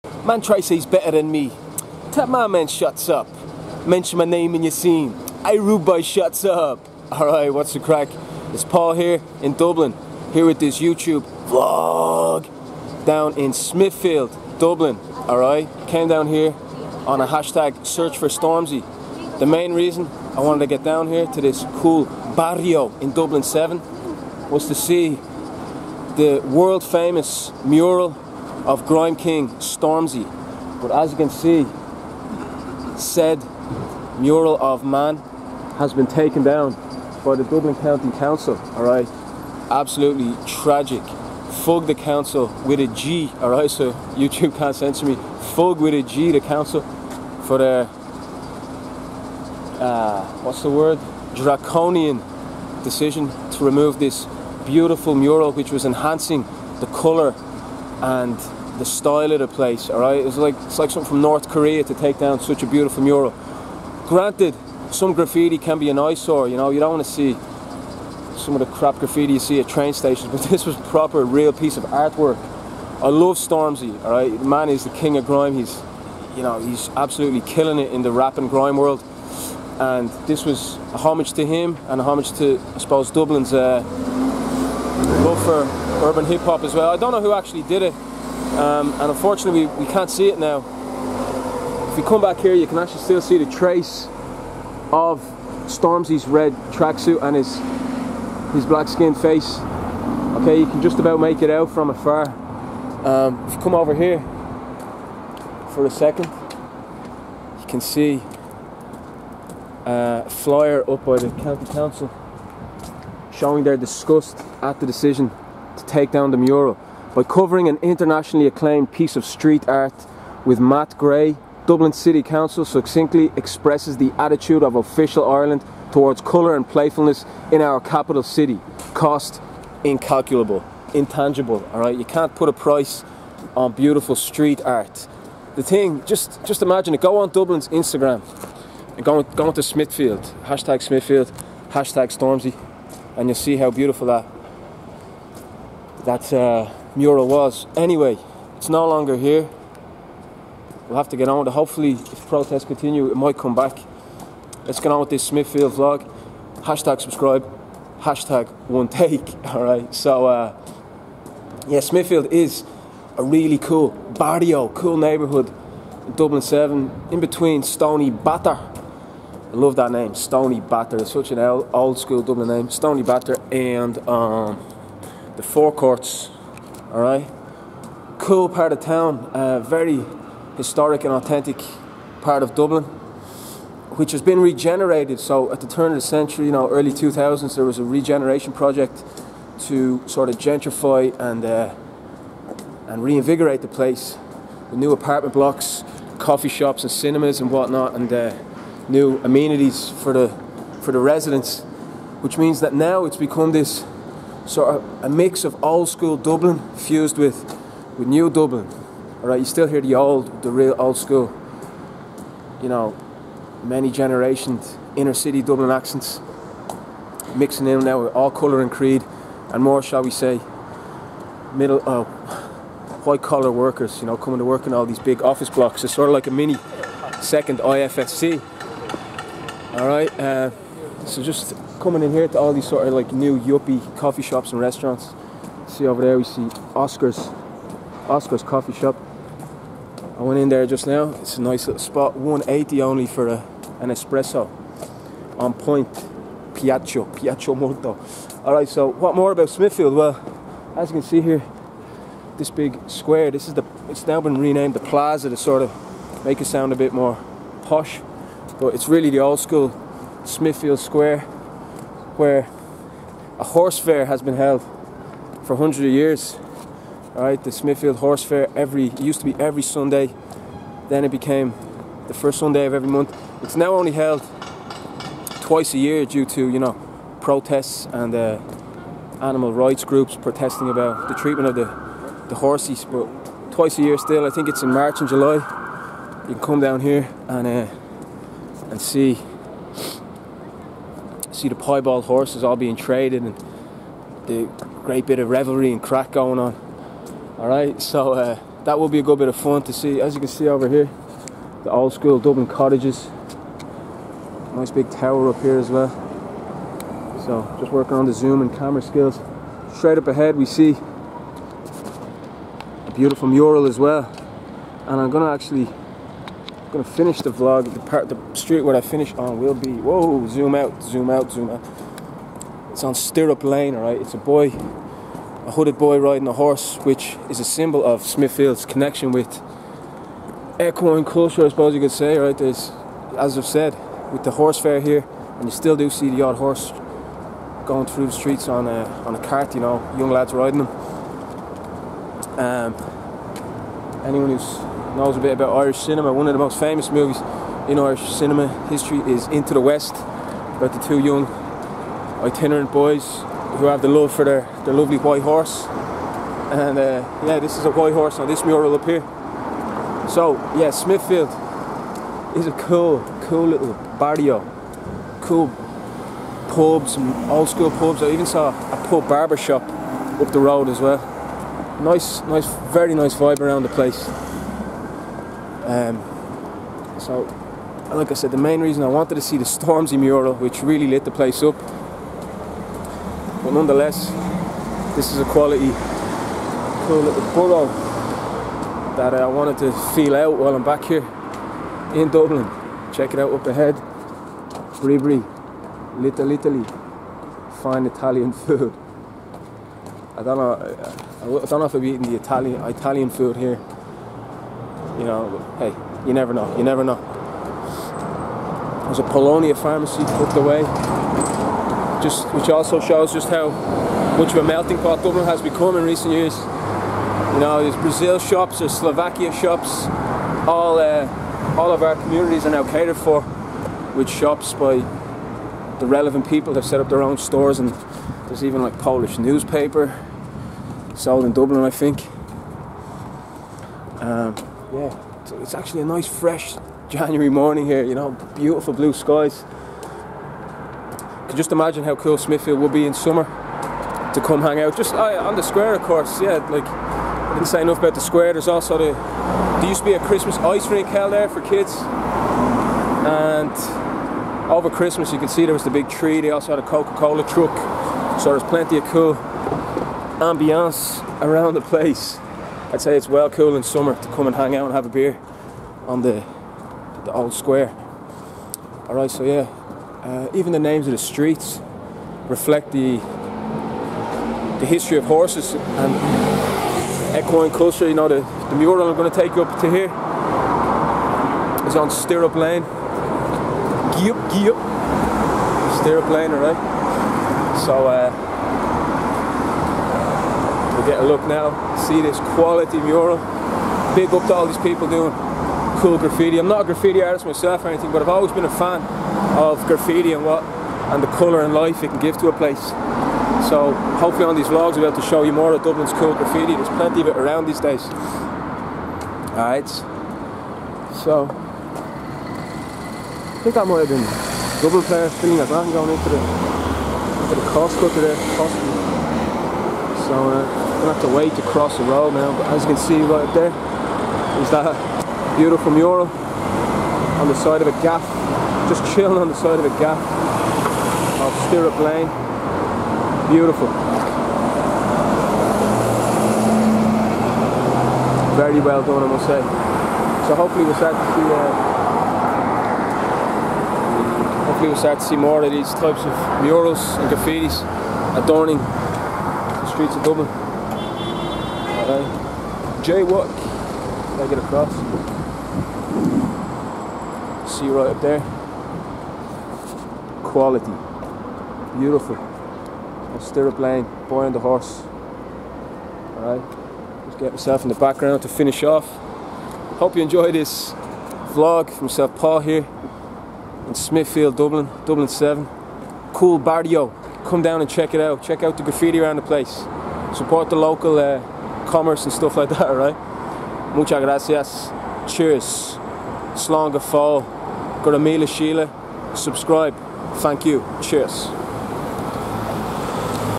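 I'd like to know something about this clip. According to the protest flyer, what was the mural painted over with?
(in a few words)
Matt Gray.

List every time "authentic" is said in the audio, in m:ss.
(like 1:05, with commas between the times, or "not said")
3:01.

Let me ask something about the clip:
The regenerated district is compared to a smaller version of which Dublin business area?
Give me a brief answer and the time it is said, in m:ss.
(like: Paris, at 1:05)
IFSC, at 3:47.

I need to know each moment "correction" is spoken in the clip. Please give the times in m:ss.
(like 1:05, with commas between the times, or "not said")
not said.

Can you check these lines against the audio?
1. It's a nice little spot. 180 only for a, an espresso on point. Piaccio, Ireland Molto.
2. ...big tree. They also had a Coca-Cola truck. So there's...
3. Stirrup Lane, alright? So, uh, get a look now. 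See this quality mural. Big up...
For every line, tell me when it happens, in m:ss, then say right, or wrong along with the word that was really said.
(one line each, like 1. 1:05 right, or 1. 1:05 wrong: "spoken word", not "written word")
1. 4:01 wrong: "Piaccio", not "Ireland"
2. 7:35 right
3. 8:05 right.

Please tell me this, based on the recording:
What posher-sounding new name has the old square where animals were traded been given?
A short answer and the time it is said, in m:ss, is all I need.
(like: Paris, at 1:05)
The Plaza, at 4:14.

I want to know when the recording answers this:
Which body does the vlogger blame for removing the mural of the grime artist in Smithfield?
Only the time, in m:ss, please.
0:37.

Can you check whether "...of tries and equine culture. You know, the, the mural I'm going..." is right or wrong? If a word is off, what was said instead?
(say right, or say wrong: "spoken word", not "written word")
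wrong: "horses", not "tries".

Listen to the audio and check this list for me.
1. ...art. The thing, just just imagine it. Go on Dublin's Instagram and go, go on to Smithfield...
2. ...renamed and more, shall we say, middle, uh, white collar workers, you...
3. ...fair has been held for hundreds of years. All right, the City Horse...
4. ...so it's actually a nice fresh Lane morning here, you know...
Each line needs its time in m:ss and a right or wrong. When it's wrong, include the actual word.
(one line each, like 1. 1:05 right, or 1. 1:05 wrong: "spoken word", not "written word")
1. 2:14 right
2. 3:38 wrong: "creed", not "renamed"
3. 4:23 wrong: "Smithfield", not "City"
4. 7:15 wrong: "January", not "Lane".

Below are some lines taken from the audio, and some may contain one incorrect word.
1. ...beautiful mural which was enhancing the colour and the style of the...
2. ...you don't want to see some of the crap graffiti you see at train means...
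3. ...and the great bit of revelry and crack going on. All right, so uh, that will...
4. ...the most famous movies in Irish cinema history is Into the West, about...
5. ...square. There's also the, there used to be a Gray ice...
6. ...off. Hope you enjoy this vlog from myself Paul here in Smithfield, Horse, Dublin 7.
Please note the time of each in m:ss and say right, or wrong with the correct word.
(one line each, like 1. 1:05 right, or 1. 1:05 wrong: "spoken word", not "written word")
1. 0:54 right
2. 1:06 wrong: "stations", not "means"
3. 4:53 right
4. 5:46 right
5. 7:28 wrong: "Christmas", not "Gray"
6. 9:28 wrong: "Dublin", not "Horse".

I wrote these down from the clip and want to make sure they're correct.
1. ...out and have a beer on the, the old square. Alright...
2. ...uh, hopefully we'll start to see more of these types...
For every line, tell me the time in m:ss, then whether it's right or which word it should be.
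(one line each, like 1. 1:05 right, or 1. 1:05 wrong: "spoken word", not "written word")
1. 7:44 right
2. 9:04 right.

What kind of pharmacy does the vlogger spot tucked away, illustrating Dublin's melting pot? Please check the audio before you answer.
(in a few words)
Polonia pharmacy.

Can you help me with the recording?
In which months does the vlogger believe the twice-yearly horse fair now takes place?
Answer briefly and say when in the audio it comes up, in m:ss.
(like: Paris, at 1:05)
March and July, at 4:44.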